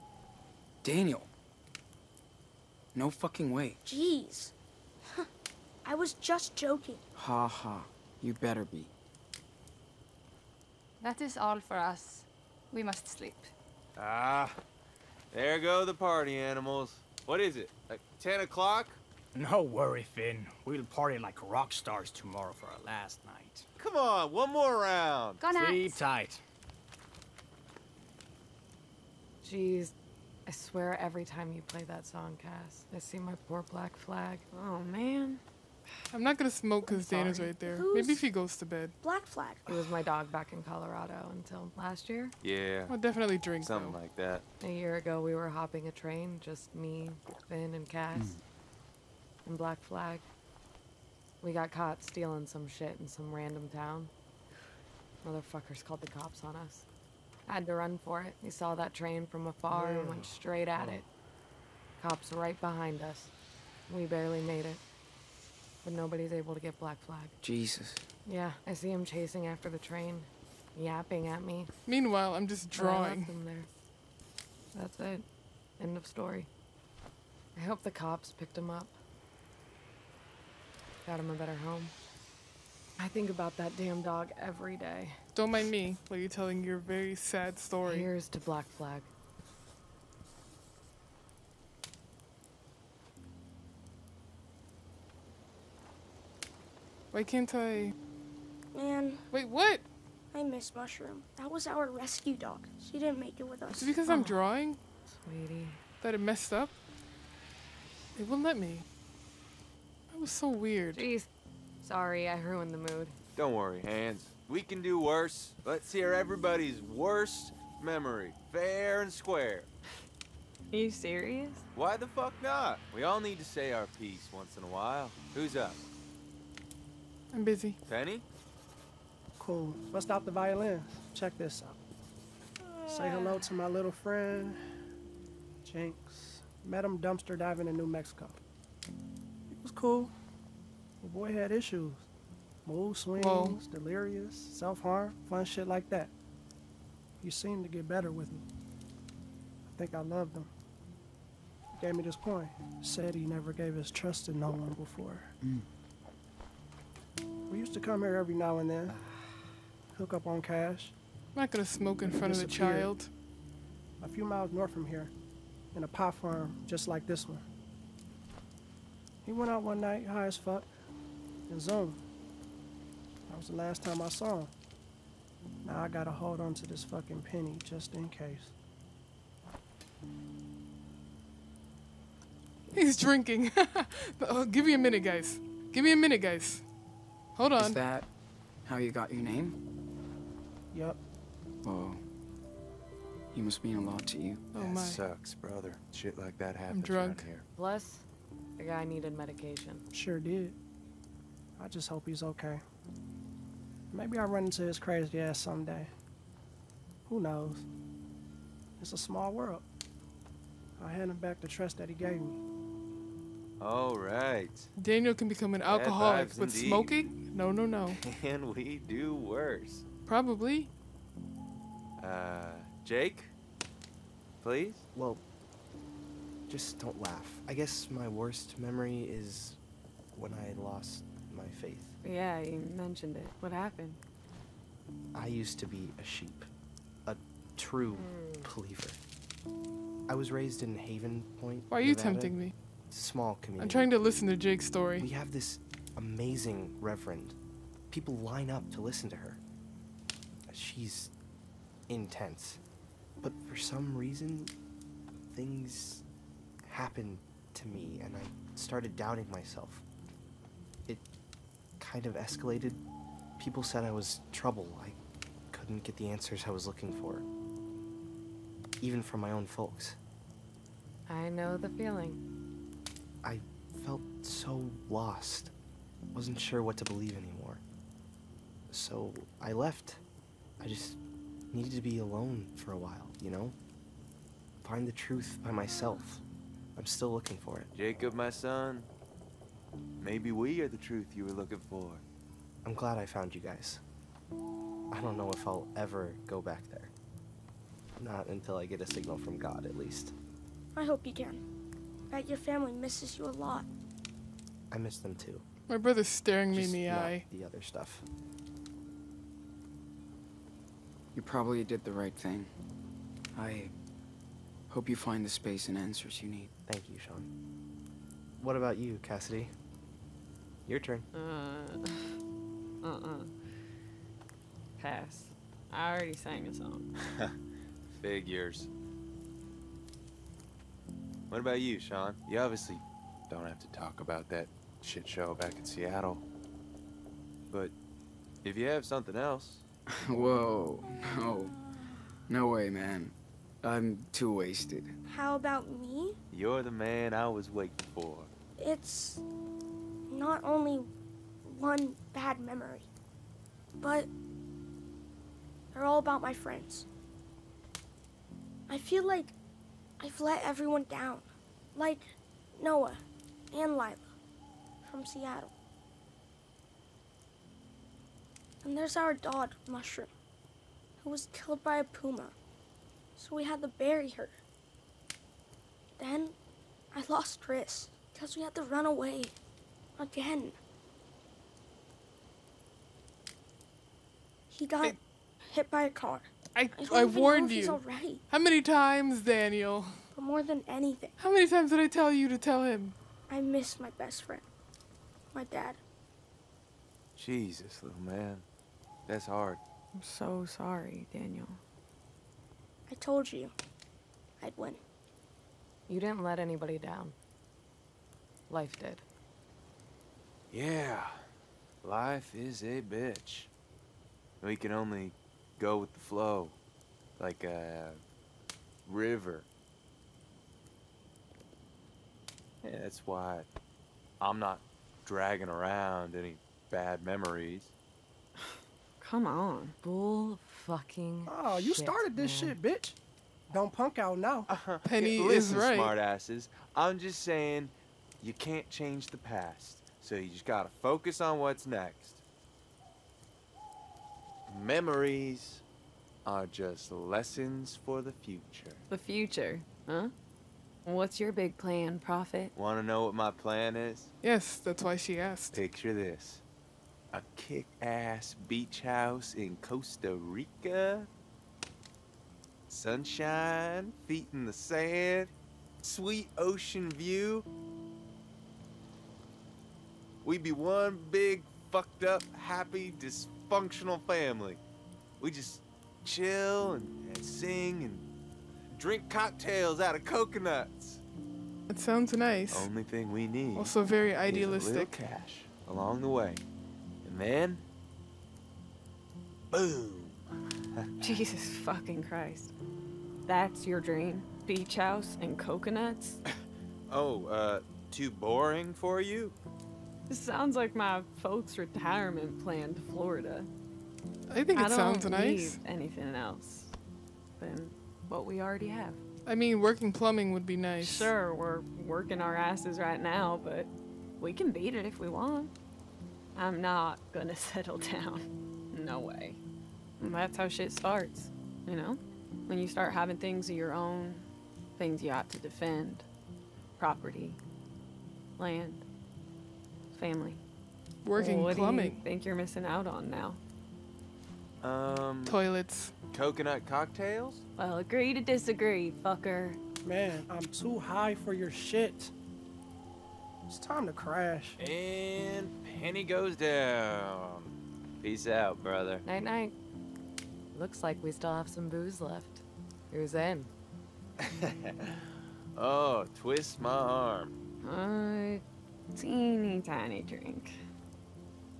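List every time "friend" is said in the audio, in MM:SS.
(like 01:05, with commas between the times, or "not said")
02:13, 05:56, 06:34.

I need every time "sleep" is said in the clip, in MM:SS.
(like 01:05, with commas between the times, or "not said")
00:13, 00:25.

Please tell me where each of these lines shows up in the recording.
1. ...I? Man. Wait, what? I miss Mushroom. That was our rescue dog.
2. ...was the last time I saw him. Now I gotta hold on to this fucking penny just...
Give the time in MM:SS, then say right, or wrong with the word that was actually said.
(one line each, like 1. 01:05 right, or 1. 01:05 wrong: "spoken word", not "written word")
1. 01:37 right
2. 02:53 right.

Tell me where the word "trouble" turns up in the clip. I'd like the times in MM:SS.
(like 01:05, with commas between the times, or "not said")
04:24.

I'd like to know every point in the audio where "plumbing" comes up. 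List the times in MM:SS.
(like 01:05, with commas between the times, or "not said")
08:29, 08:51.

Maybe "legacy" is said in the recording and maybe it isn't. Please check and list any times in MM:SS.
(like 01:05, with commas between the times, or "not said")
not said.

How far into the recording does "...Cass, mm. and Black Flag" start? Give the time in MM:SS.
00:47.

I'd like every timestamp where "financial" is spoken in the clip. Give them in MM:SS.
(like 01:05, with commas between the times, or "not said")
not said.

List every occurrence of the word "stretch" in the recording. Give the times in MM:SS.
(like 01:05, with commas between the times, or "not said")
not said.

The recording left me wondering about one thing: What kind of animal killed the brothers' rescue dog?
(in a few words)
A puma.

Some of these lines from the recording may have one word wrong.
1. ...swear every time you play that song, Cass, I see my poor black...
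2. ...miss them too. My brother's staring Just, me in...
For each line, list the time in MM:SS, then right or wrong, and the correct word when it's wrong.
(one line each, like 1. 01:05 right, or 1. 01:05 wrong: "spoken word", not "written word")
1. 00:30 right
2. 05:04 right.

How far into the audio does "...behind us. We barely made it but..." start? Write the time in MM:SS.
01:02.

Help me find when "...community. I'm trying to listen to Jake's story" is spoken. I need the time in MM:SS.
04:03.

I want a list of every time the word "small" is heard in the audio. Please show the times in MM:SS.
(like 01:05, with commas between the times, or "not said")
03:28, 04:03.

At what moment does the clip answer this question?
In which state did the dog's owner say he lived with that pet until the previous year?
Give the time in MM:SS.
00:40.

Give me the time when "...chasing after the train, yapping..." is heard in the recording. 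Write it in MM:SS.
01:09.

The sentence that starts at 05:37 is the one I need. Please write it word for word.
But if you have something else.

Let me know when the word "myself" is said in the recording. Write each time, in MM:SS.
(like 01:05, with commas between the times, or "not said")
04:19, 04:45.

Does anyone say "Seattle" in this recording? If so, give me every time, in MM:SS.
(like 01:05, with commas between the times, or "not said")
05:35, 06:05.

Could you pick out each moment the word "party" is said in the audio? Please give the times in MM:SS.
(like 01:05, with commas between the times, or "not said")
00:15, 00:20.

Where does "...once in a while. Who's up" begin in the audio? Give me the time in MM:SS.
02:04.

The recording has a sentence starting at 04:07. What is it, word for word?
People line up to listen to her.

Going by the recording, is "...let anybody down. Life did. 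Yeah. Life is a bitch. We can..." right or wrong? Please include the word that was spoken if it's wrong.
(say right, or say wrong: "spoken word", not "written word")
right.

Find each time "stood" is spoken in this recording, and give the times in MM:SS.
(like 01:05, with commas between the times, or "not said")
not said.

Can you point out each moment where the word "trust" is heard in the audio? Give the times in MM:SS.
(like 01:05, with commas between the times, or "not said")
02:33, 03:31.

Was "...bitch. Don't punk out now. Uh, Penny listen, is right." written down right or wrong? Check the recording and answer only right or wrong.
right.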